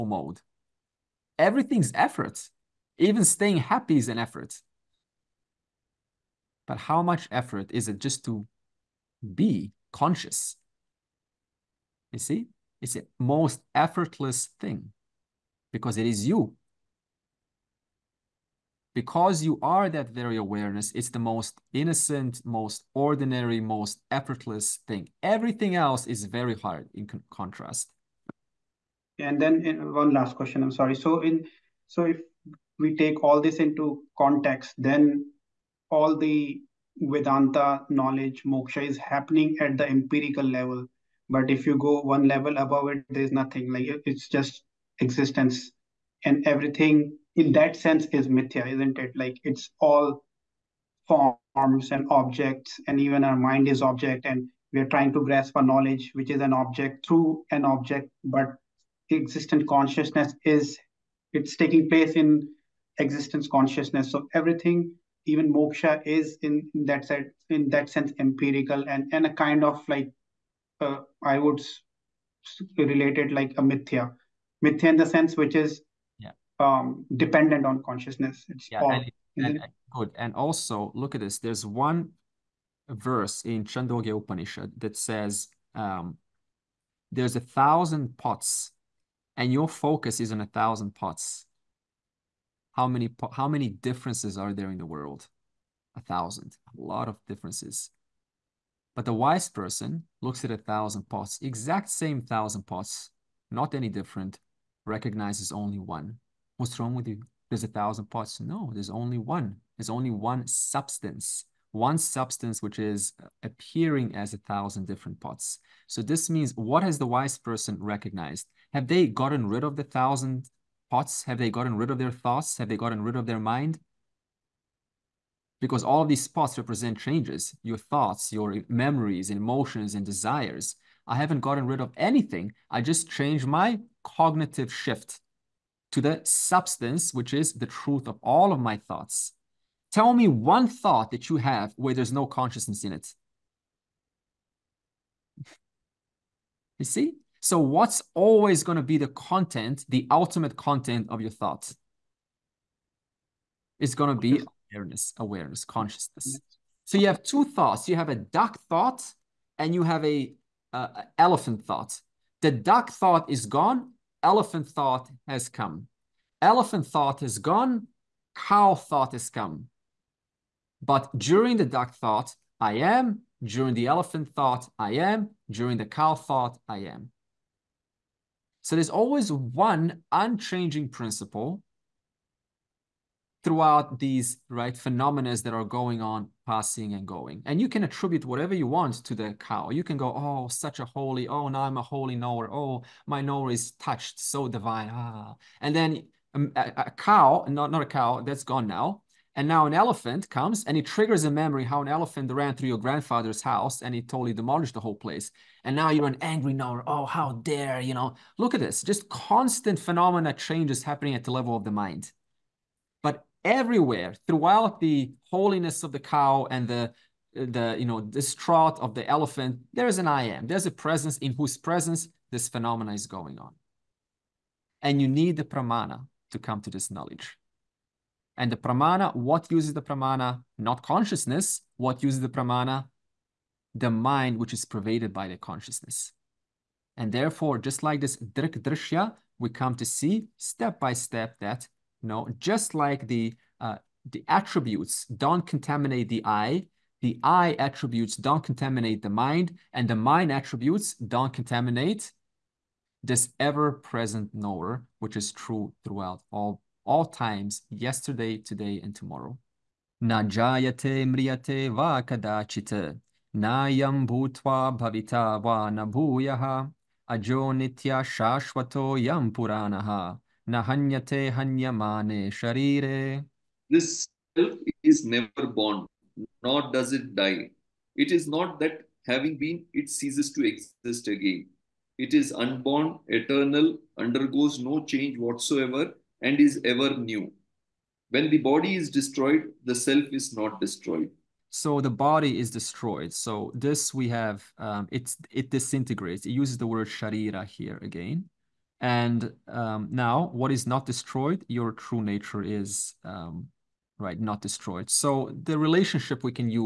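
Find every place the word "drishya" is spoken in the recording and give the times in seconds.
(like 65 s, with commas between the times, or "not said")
238 s.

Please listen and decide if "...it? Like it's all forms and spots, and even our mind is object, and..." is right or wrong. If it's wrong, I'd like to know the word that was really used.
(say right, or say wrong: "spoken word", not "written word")
wrong: "objects", not "spots".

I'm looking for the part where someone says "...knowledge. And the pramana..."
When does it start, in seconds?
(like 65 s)
226 s.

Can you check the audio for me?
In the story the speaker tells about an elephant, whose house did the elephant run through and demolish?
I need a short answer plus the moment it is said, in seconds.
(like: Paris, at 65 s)
grandfather's house, at 202 s.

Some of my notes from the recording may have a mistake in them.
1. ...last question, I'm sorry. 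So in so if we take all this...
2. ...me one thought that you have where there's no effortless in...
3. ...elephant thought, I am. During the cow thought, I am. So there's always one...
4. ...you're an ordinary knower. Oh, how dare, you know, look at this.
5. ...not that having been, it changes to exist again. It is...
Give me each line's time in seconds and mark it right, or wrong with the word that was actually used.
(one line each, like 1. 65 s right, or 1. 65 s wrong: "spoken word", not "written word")
1. 30 s right
2. 140 s wrong: "consciousness", not "effortless"
3. 173 s right
4. 205 s wrong: "angry", not "ordinary"
5. 278 s wrong: "ceases", not "changes".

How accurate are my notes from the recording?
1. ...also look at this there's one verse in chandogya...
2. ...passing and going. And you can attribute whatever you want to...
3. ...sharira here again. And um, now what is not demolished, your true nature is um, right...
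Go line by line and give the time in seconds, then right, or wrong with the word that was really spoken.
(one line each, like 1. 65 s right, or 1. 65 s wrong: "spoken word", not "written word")
1. 80 s right
2. 186 s right
3. 296 s wrong: "destroyed", not "demolished".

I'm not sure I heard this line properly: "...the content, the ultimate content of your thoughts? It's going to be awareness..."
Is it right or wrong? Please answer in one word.
right.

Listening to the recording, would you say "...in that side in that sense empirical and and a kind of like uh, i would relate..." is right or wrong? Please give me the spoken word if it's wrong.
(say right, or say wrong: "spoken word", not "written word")
right.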